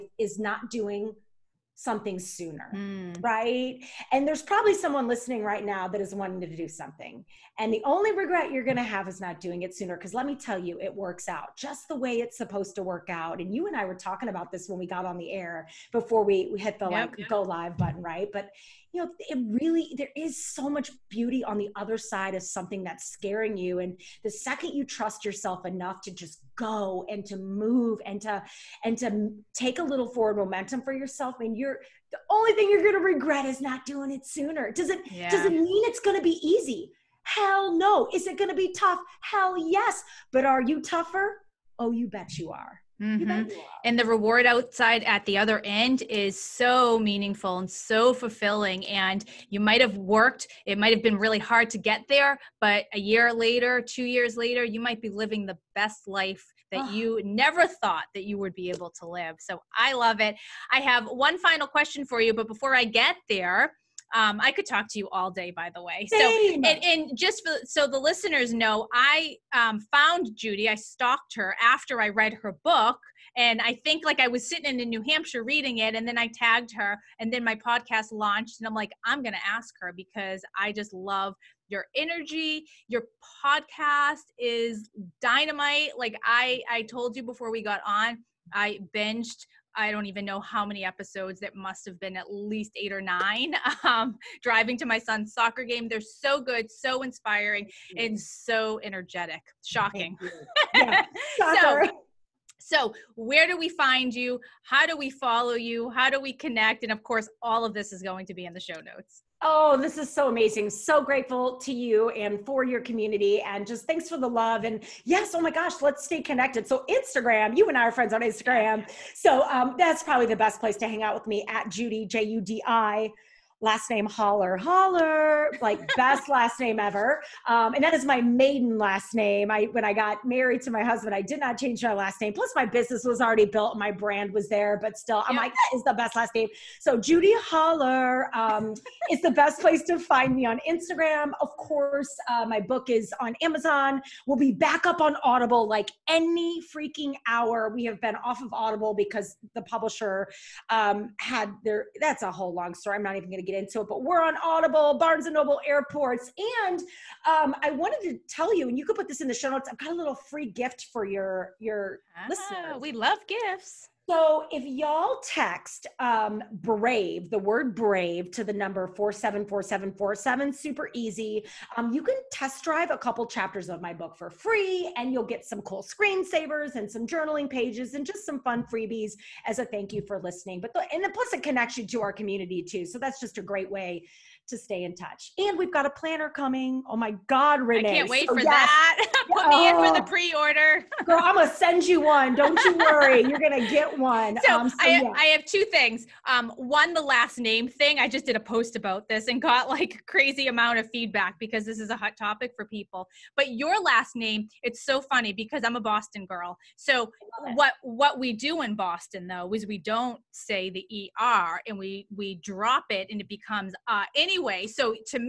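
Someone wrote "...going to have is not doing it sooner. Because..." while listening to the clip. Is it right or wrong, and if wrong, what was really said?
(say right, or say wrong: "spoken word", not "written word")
right.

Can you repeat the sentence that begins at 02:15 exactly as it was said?
like, that is the best last name.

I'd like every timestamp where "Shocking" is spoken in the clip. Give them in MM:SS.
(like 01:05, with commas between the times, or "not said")
01:39.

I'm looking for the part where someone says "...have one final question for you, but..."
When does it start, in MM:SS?
01:00.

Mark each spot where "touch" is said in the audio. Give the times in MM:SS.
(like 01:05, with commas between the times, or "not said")
03:04.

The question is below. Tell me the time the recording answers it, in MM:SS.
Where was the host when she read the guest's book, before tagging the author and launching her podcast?
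01:14.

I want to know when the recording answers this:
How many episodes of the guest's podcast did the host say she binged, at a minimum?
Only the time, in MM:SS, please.
01:32.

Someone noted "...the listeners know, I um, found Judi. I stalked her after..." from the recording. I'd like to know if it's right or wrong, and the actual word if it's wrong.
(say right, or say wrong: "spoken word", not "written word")
right.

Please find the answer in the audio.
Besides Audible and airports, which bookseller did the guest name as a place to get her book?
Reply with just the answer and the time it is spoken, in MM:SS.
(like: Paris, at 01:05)
Barnes and Noble, at 02:34.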